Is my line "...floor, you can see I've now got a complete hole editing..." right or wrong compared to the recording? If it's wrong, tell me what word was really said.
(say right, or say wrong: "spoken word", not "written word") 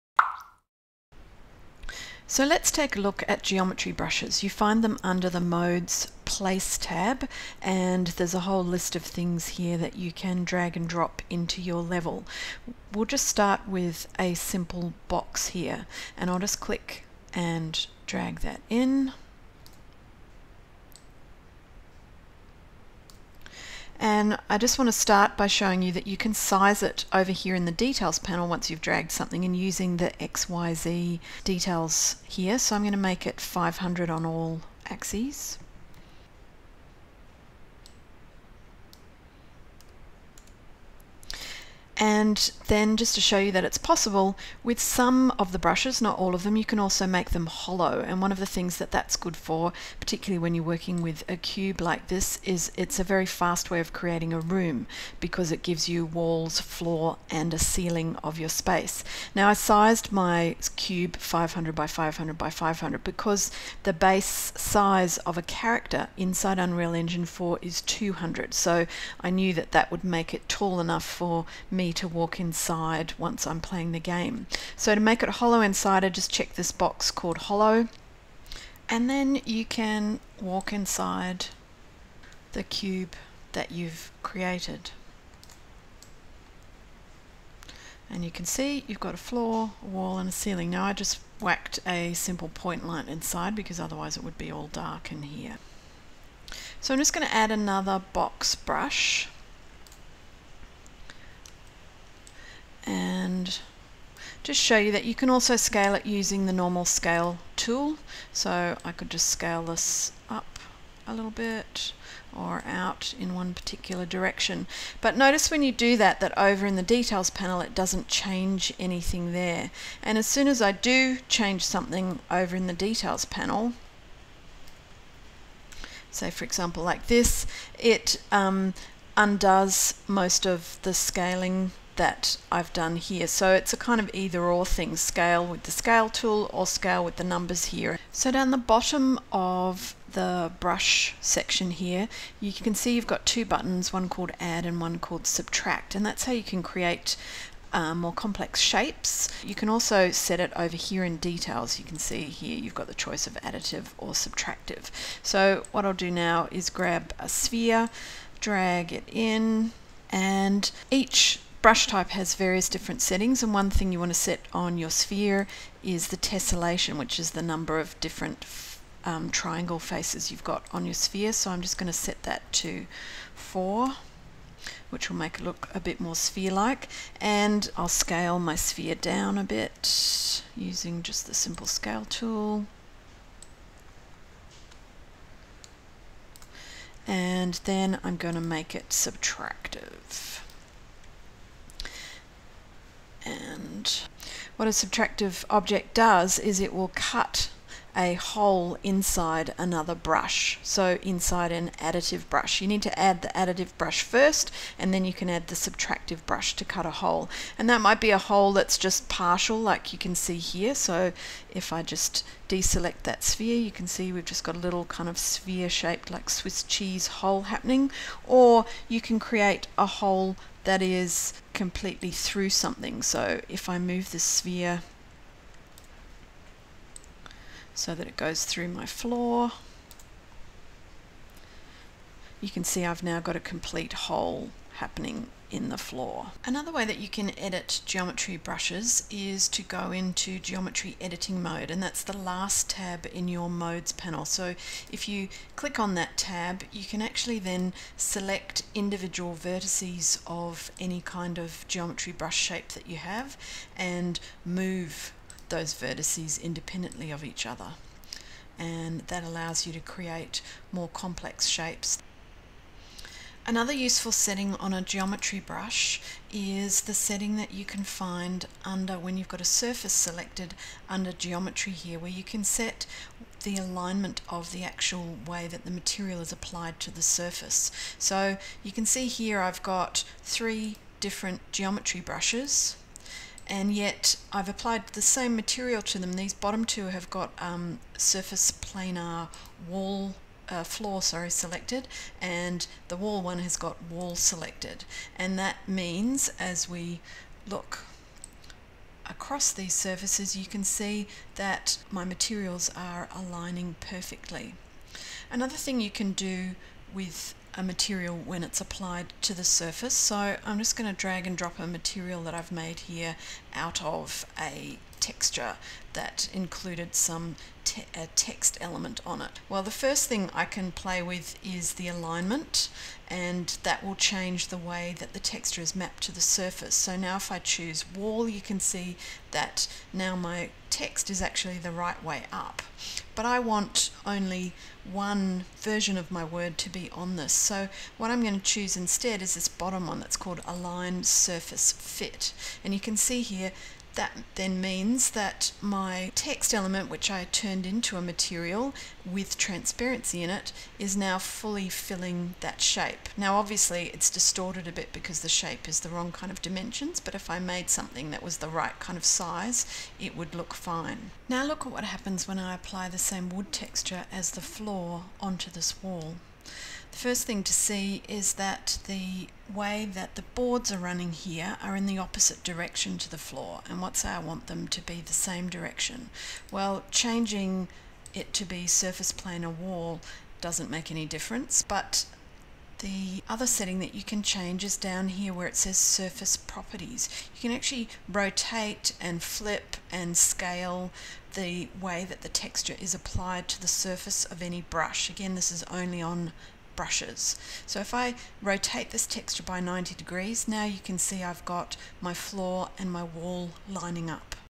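wrong: "happening", not "editing".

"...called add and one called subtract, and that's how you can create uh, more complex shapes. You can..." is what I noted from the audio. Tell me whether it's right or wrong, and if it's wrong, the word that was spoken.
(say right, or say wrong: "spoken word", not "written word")
right.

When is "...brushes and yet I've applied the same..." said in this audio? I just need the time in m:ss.
4:41.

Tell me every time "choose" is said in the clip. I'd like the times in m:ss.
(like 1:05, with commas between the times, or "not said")
5:27, 5:38.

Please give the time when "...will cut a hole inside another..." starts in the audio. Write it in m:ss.
3:16.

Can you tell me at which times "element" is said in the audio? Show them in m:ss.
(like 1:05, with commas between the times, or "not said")
5:18, 5:46.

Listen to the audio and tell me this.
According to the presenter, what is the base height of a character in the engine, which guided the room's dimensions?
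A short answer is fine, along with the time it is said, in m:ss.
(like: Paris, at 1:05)
200, at 1:07.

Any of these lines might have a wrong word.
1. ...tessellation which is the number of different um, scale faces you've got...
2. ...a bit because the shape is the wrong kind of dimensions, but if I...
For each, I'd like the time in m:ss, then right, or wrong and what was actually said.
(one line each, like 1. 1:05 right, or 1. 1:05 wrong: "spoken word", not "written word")
1. 2:46 wrong: "triangle", not "scale"
2. 5:54 right.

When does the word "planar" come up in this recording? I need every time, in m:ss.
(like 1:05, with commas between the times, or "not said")
4:48, 6:19.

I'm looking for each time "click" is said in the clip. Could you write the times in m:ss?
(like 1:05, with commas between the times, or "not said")
0:16, 4:05.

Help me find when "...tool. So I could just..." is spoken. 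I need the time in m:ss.
1:47.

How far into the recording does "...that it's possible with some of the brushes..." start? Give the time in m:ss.
0:43.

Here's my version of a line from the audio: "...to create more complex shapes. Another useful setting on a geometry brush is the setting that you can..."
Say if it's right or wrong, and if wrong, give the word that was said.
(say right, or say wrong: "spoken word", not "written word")
right.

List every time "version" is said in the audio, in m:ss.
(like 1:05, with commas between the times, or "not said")
5:35.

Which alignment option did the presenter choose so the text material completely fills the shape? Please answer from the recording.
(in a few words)
align surface fit.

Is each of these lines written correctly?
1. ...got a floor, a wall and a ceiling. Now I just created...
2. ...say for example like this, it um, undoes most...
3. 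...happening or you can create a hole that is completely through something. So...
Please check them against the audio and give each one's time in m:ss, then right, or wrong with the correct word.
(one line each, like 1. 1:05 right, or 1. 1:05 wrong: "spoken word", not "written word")
1. 1:28 wrong: "whacked", not "created"
2. 2:06 right
3. 3:37 right.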